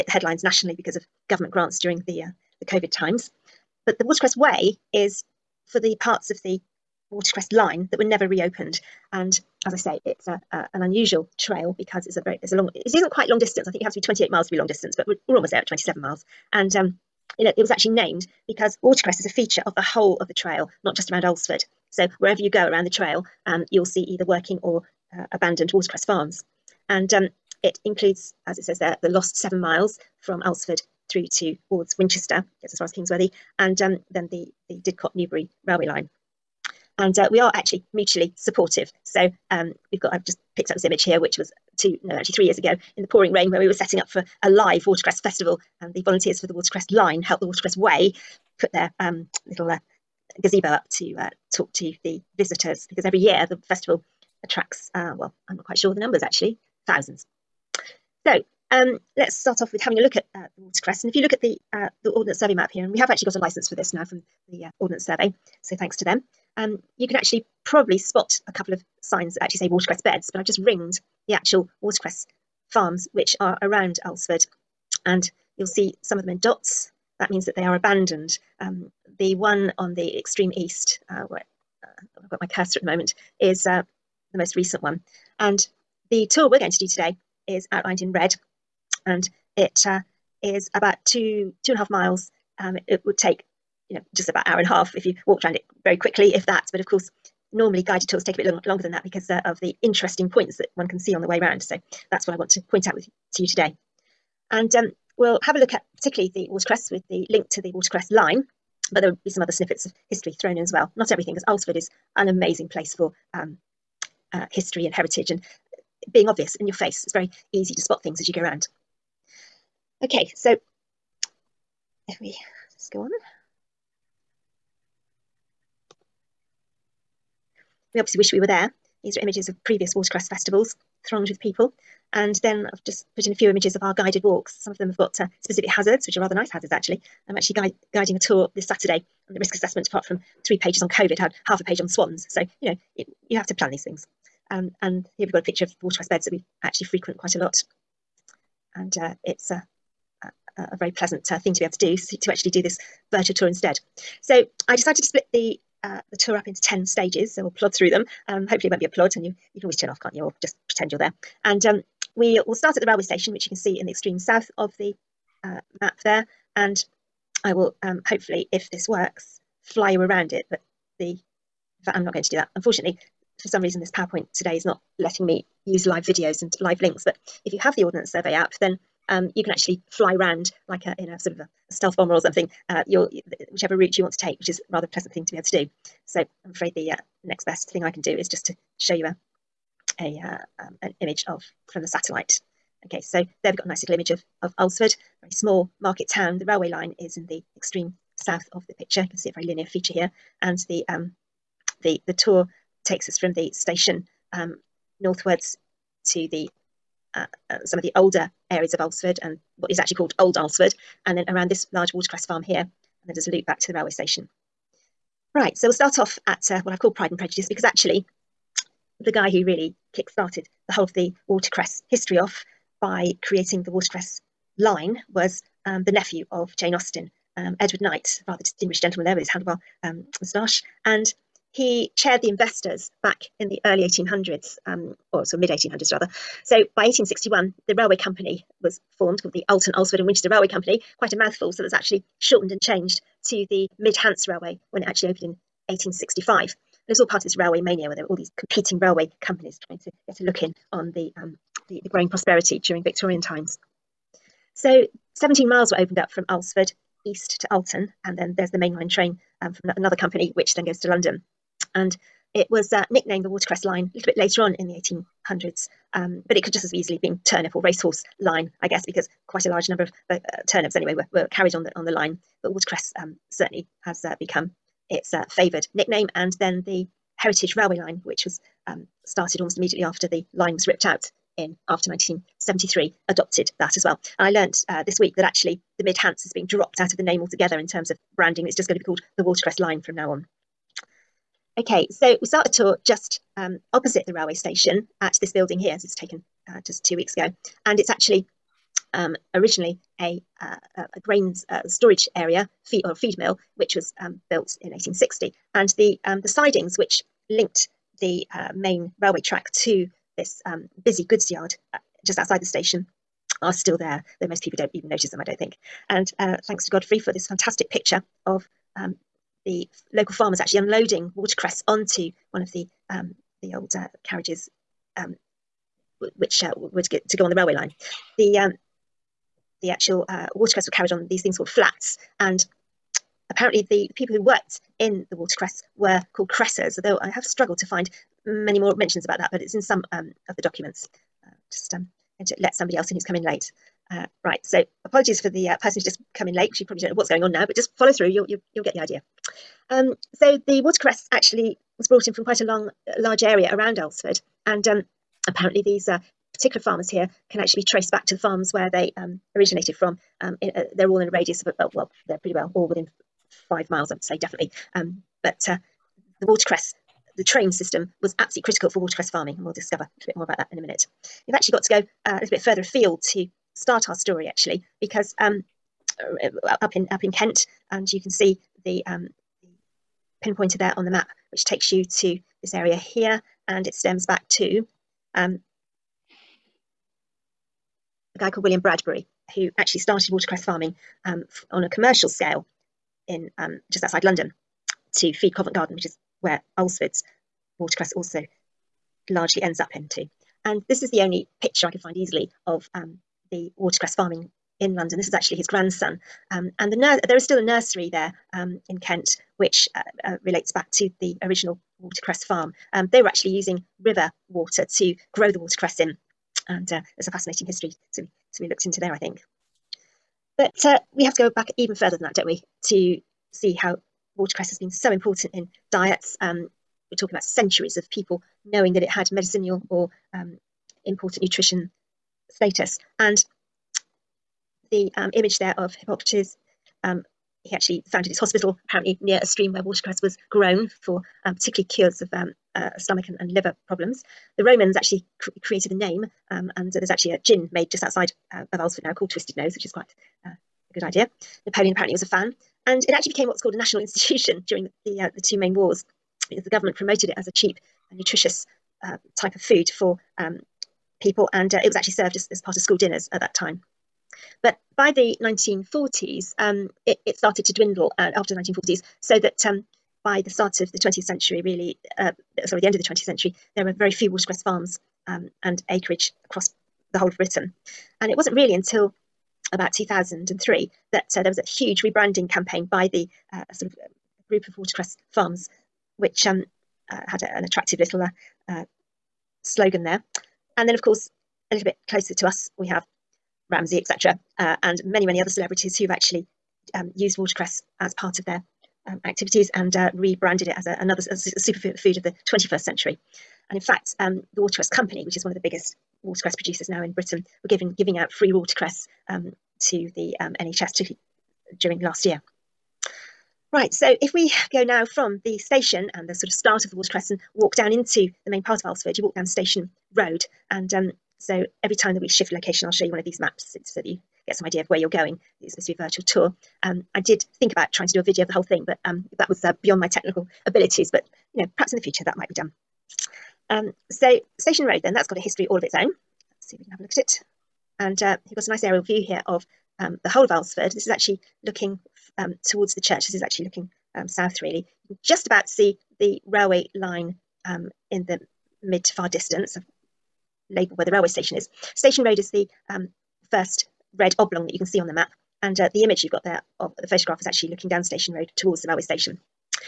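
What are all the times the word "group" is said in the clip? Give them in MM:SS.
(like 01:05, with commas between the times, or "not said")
08:04.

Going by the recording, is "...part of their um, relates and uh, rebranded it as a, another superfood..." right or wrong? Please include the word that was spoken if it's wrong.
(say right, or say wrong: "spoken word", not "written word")
wrong: "activities", not "relates".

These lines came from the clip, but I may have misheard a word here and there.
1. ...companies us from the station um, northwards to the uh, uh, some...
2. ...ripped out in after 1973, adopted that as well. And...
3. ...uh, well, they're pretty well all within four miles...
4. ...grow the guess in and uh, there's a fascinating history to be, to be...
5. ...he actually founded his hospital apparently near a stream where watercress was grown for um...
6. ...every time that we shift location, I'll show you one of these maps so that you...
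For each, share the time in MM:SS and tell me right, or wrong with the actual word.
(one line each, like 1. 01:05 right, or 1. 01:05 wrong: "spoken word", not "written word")
1. 03:22 wrong: "takes", not "companies"
2. 04:40 right
3. 06:01 wrong: "five", not "four"
4. 06:55 wrong: "watercress", not "guess"
5. 07:17 right
6. 08:41 right.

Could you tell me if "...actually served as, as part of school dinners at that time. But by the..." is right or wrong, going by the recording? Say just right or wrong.
right.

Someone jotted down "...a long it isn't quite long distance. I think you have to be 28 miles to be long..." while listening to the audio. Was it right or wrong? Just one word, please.
right.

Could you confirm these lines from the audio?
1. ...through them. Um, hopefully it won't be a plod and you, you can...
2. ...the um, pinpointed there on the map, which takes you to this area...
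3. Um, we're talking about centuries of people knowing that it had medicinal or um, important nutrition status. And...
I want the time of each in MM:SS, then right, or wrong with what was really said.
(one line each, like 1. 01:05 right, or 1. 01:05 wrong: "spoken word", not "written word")
1. 02:37 right
2. 06:18 right
3. 07:06 right.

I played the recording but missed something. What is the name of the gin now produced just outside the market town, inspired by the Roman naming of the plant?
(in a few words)
Twisted Nose.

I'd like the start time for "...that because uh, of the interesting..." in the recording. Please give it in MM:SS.
01:38.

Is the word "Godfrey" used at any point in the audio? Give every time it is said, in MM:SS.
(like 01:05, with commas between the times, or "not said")
05:16.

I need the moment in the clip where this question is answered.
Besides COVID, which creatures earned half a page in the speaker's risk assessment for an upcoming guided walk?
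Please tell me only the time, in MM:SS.
02:21.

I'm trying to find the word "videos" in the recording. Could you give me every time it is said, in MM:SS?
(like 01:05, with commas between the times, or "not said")
02:56, 08:48.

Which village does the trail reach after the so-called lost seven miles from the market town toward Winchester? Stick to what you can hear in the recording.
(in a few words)
Kings Worthy.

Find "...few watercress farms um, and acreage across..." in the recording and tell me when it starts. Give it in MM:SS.
07:53.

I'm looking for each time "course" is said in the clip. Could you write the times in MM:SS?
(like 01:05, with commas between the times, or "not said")
01:36, 08:10.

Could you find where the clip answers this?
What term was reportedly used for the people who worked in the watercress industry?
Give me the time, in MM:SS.
05:36.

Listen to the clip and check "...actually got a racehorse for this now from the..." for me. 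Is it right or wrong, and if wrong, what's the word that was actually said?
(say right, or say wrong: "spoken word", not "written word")
wrong: "license", not "racehorse".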